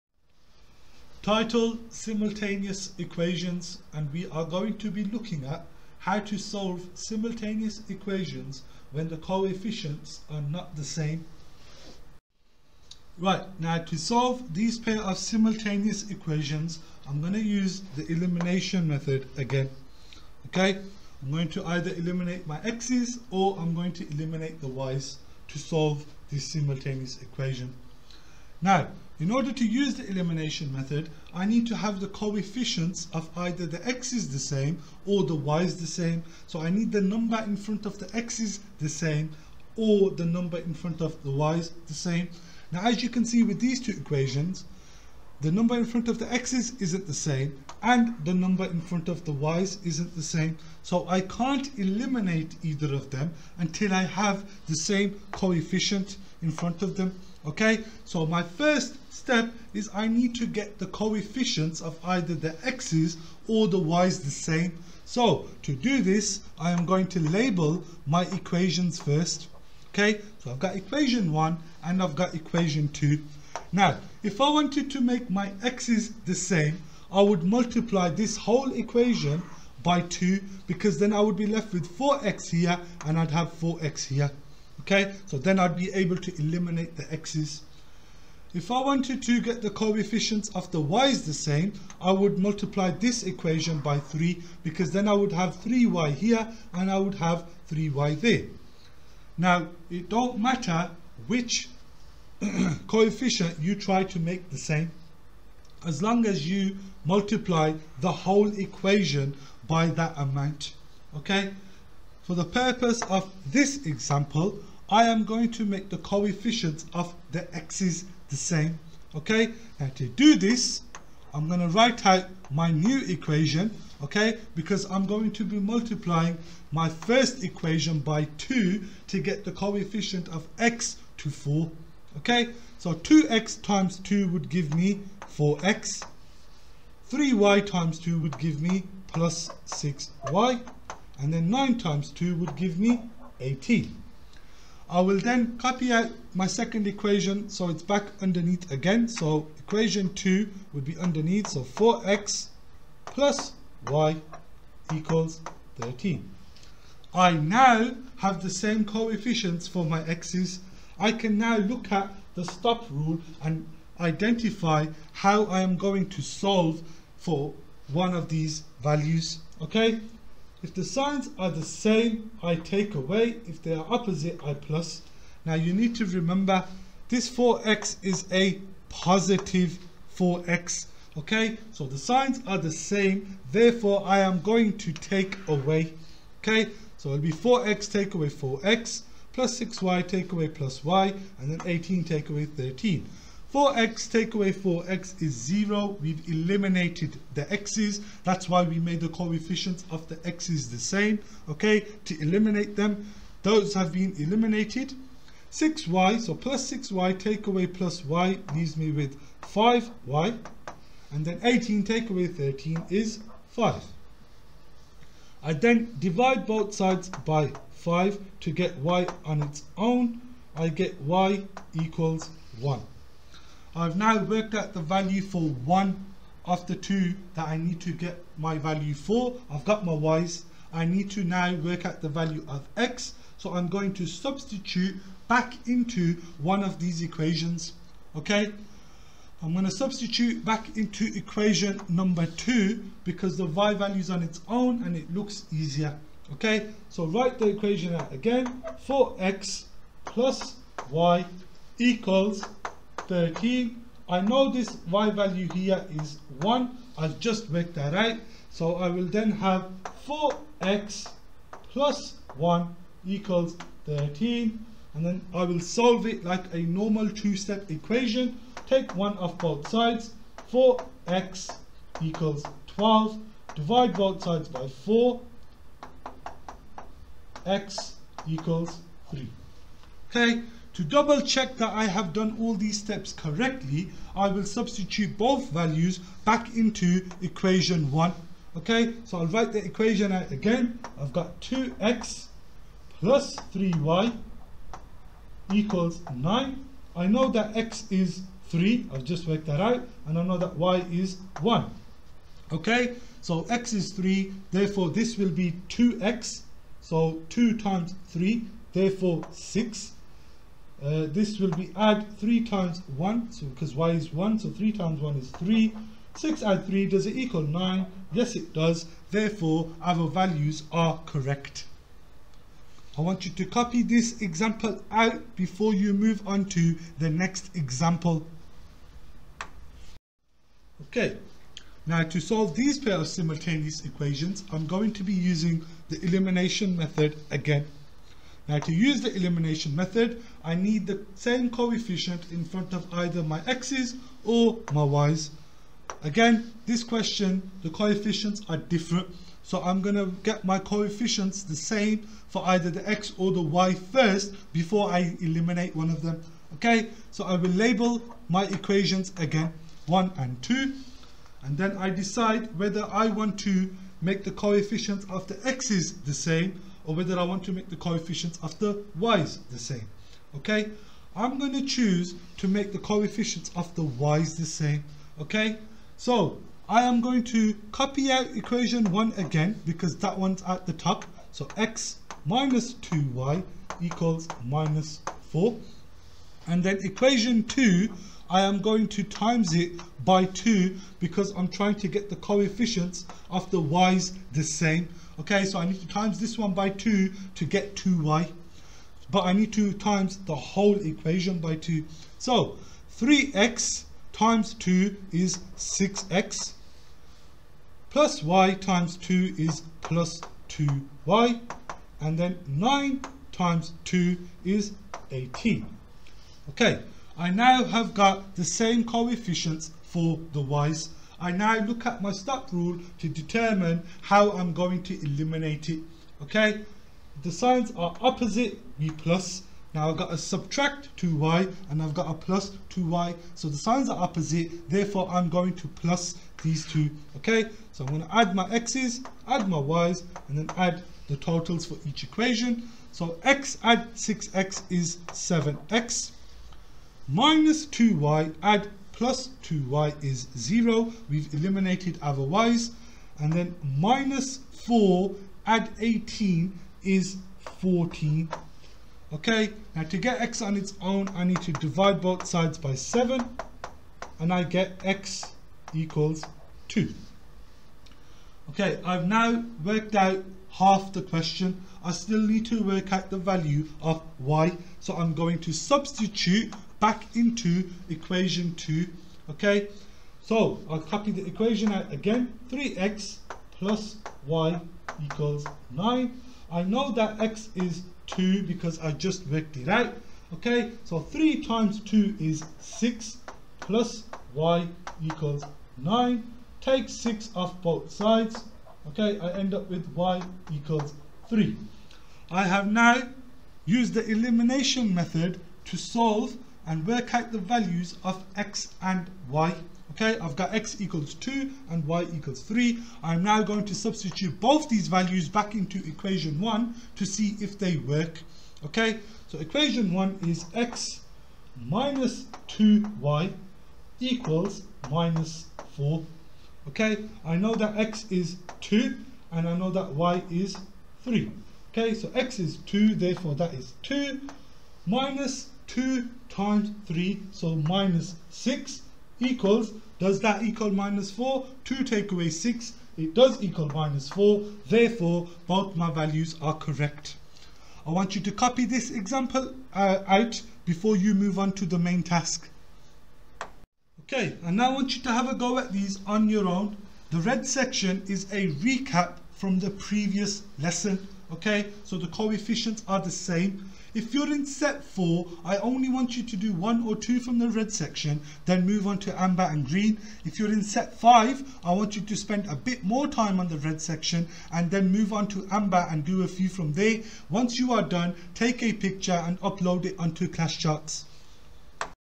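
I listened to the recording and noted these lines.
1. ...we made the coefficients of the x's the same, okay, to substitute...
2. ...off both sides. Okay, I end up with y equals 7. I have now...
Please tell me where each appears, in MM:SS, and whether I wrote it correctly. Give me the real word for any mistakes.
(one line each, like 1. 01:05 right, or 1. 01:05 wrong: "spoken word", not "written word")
1. 03:18 wrong: "eliminate", not "substitute"
2. 08:17 wrong: "3", not "7".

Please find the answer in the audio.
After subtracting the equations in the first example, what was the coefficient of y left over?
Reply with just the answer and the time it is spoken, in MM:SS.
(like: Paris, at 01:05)
5y, at 03:29.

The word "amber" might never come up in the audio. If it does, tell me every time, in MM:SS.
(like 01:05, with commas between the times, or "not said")
09:29, 09:35.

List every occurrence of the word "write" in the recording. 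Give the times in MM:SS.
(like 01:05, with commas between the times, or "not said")
02:01, 04:07, 04:49.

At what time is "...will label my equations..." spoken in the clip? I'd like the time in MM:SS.
05:57.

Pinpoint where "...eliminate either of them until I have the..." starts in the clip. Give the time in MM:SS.
00:51.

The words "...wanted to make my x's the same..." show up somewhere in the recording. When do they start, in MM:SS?
01:14.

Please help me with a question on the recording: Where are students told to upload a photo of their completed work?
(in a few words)
Class Charts.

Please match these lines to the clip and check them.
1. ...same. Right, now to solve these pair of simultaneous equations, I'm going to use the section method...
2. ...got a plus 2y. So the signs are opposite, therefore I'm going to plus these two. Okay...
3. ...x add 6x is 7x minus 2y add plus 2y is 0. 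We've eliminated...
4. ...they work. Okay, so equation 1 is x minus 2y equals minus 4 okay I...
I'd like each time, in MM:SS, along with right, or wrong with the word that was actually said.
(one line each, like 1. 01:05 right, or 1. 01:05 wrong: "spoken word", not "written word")
1. 00:10 wrong: "elimination", not "section"
2. 07:11 right
3. 07:23 right
4. 08:37 right.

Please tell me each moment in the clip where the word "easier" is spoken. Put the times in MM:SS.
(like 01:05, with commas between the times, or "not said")
04:05.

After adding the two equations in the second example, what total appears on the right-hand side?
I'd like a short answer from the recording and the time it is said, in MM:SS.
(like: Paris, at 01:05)
14, at 07:37.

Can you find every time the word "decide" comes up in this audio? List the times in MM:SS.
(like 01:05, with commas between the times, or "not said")
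06:01.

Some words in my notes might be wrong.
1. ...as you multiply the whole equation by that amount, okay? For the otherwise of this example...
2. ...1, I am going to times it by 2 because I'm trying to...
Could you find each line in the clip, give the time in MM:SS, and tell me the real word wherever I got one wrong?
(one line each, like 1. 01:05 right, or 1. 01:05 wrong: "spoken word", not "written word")
1. 01:46 wrong: "purpose", not "otherwise"
2. 06:27 wrong: "2", not "1".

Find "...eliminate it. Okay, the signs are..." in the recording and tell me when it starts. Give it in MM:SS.
07:05.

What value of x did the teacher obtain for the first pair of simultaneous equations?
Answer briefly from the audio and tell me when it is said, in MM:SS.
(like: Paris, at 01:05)
x equals 3, at 04:37.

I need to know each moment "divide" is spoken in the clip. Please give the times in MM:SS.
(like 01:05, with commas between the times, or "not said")
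03:35, 04:33, 07:41.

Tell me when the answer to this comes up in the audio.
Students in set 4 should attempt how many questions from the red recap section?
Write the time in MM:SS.
09:26.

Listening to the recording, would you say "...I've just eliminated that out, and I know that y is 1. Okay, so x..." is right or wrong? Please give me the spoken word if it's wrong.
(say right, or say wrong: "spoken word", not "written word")
wrong: "worked", not "eliminated".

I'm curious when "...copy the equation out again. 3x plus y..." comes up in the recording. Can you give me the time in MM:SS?
08:00.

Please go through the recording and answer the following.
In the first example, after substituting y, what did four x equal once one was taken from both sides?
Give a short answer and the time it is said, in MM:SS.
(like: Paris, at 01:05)
12, at 04:30.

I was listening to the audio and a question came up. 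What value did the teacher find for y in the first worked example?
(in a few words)
y equals 1.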